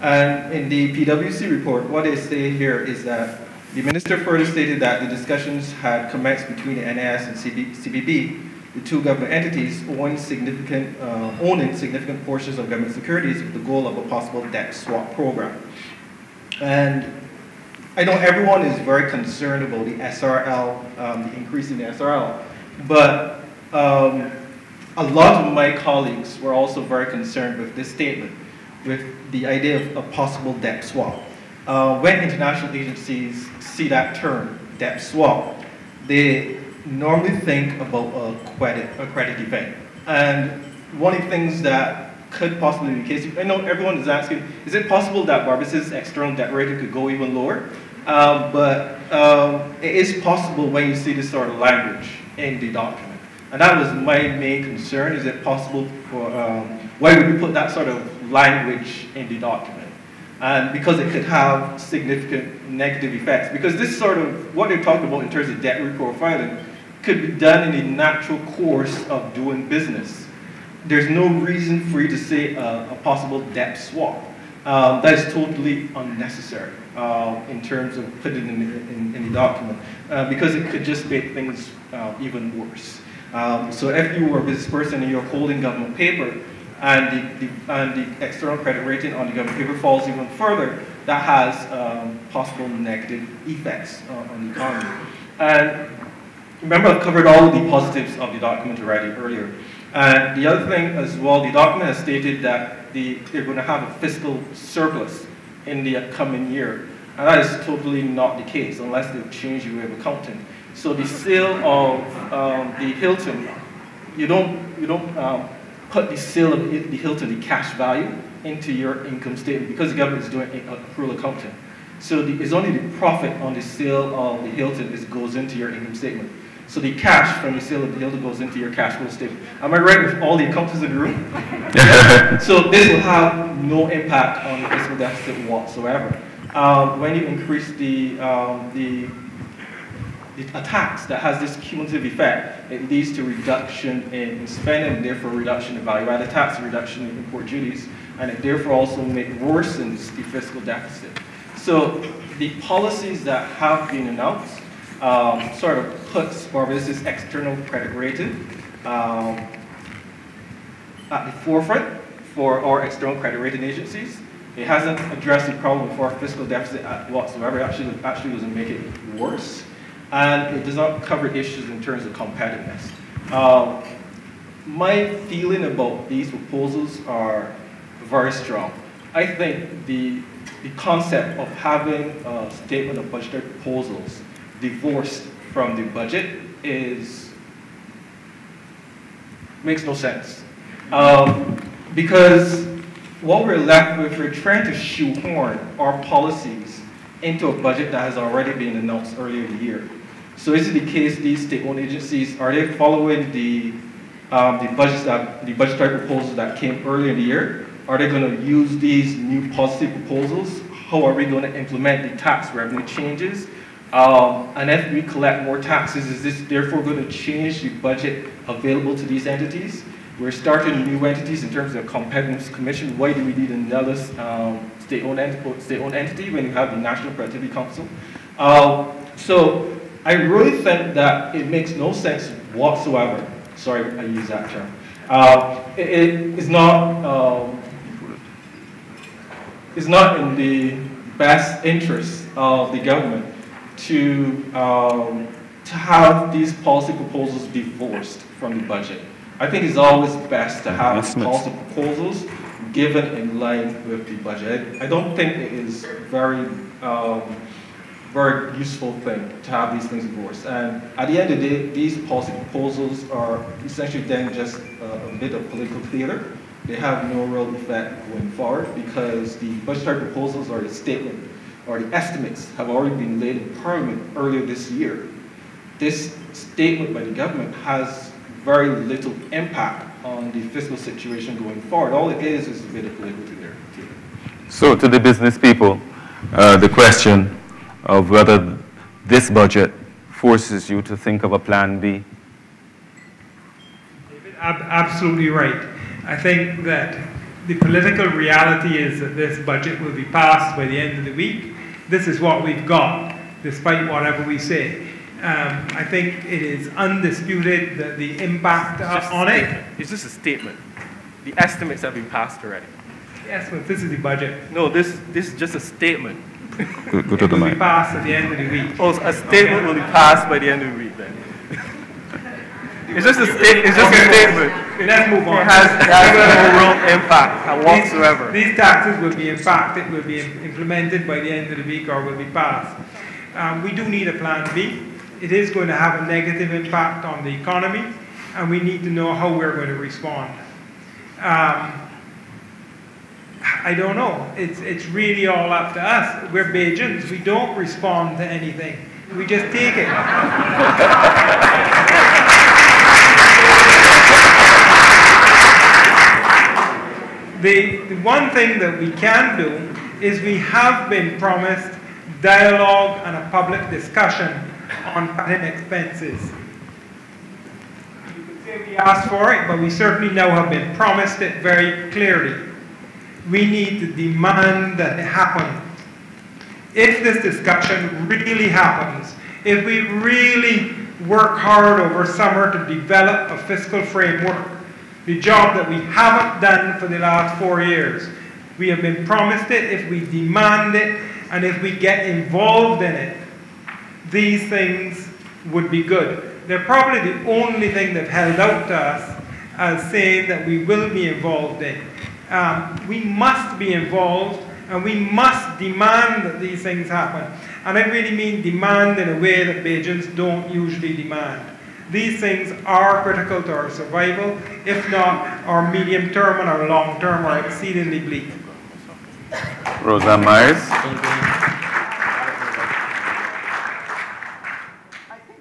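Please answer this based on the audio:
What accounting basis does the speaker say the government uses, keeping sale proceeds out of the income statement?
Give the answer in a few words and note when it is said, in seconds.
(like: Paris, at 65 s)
accrual accounting, at 120 s.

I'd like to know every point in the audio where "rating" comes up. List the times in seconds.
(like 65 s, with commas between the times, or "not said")
46 s, 88 s, 157 s, 163 s.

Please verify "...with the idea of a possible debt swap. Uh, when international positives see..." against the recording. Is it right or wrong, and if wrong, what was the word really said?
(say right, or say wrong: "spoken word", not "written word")
wrong: "agencies", not "positives".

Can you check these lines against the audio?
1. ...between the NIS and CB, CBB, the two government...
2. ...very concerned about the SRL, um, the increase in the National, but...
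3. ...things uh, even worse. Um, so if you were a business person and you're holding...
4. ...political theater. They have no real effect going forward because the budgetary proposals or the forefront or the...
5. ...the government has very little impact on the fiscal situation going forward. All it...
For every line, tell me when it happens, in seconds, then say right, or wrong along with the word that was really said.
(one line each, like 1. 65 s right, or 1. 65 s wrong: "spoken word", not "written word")
1. 6 s right
2. 18 s wrong: "SRL", not "National"
3. 81 s right
4. 265 s wrong: "statement", not "forefront"
5. 277 s right.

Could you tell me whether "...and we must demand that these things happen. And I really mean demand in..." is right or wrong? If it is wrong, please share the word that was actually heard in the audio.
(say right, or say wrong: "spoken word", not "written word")
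right.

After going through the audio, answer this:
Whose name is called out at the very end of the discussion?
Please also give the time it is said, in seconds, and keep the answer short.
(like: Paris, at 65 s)
Rosa Myers, at 419 s.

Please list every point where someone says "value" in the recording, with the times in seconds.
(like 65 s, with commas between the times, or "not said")
117 s, 145 s.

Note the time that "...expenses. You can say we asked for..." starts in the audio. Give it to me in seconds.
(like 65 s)
365 s.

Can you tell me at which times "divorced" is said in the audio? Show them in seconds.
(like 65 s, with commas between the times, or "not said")
184 s, 247 s.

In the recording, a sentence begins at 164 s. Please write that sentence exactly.
It hasn't addressed the problem for our fiscal deficit whatsoever.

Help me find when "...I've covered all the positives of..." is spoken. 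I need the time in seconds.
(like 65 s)
96 s.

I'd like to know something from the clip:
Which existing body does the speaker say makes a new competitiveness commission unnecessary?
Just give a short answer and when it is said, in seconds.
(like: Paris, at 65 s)
National Productivity Council, at 226 s.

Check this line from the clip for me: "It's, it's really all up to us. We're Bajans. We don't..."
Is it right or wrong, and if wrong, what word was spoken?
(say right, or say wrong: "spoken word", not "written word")
right.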